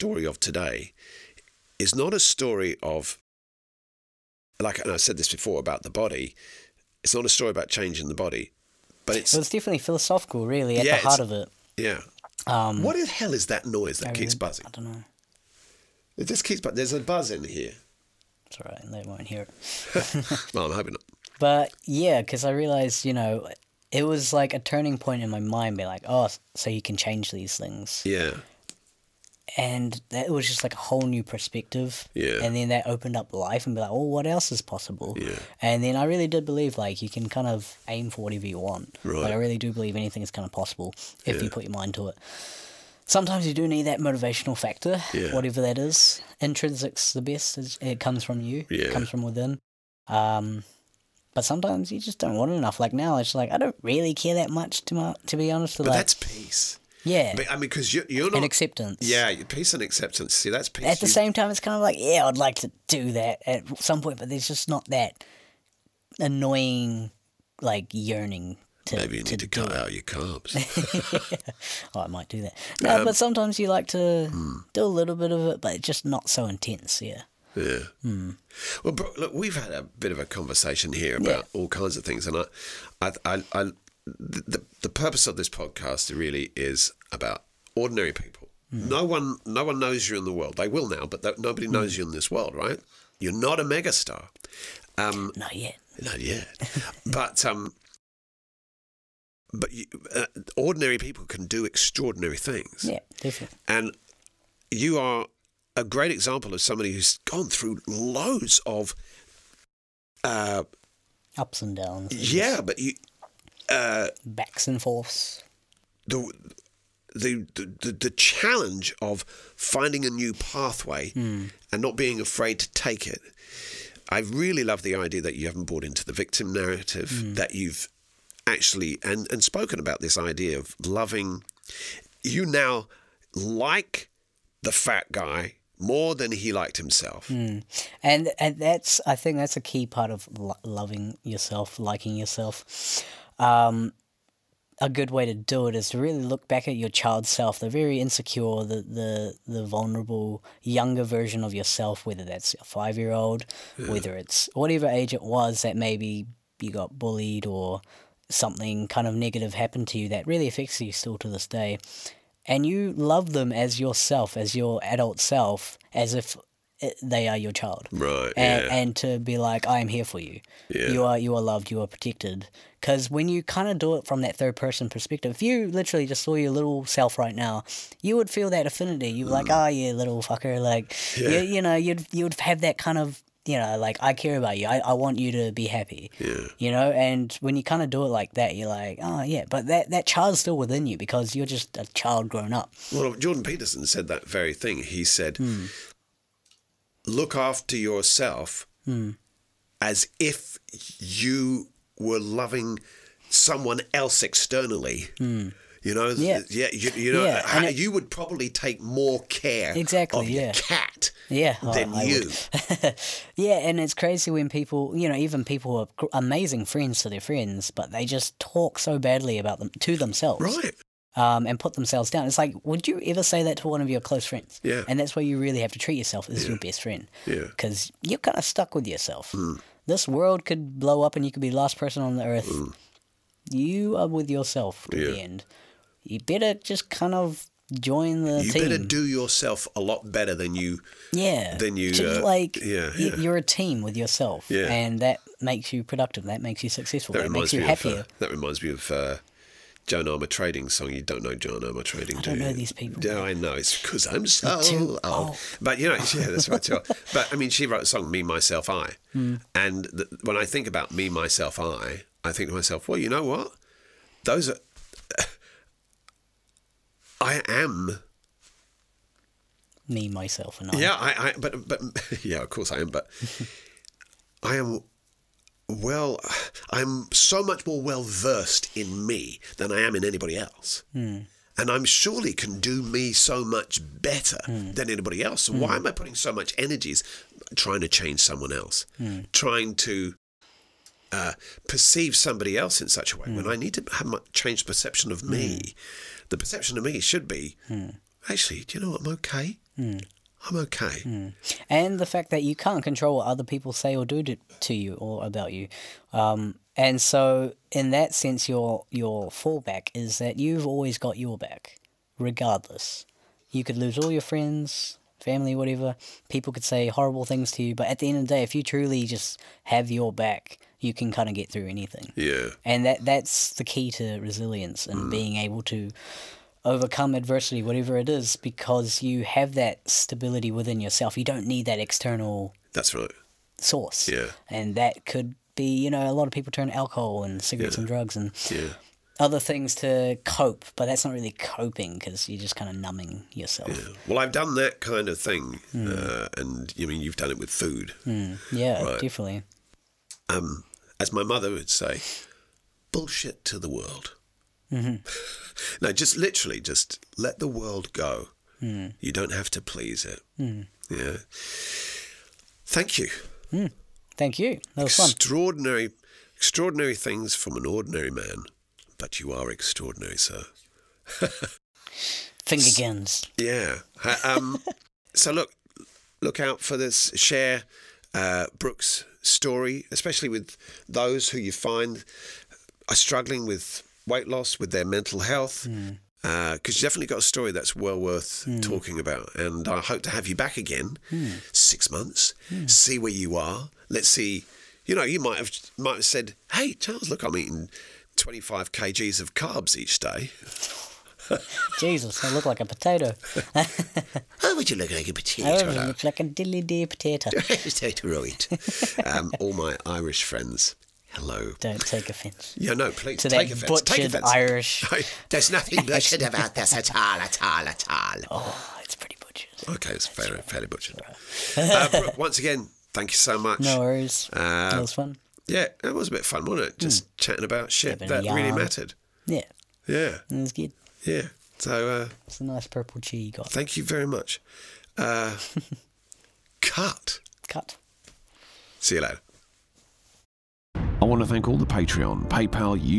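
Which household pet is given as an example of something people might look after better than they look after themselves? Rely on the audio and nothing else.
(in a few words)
Cat.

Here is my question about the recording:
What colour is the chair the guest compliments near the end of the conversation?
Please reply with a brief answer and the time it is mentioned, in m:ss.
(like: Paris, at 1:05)
Purple, at 7:12.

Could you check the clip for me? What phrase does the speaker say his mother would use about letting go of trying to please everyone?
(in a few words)
Bullshit to the world.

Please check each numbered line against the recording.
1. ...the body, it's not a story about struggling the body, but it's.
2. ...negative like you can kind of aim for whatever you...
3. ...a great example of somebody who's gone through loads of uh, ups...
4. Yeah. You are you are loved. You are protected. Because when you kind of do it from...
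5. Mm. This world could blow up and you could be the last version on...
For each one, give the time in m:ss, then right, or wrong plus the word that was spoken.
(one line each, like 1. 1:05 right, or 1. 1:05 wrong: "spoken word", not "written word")
1. 0:05 wrong: "changing", not "struggling"
2. 0:36 wrong: "believe", not "negative"
3. 1:45 right
4. 2:50 right
5. 3:49 wrong: "person", not "version".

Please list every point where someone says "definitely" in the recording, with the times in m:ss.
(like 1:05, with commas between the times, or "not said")
0:09, 1:43, 5:49, 6:26.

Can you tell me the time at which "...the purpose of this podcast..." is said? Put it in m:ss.
1:24.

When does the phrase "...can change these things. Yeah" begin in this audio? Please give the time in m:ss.
0:26.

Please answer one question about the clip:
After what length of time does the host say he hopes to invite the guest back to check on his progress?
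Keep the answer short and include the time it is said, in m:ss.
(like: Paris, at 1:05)
6 months, at 6:31.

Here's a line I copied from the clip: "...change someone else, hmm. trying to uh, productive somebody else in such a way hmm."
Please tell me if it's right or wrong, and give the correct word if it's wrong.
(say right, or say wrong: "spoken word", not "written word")
wrong: "perceive", not "productive".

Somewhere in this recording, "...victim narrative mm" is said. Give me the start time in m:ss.
2:06.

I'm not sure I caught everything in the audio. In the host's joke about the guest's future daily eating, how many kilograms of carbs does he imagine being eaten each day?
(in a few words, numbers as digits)
25.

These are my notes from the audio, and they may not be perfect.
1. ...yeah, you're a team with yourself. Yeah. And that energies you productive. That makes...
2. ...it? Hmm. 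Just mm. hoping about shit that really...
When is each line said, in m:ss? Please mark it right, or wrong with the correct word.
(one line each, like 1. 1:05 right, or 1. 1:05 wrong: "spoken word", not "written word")
1. 4:02 wrong: "makes", not "energies"
2. 7:06 wrong: "chatting", not "hoping".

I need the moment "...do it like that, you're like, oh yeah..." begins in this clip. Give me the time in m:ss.
3:07.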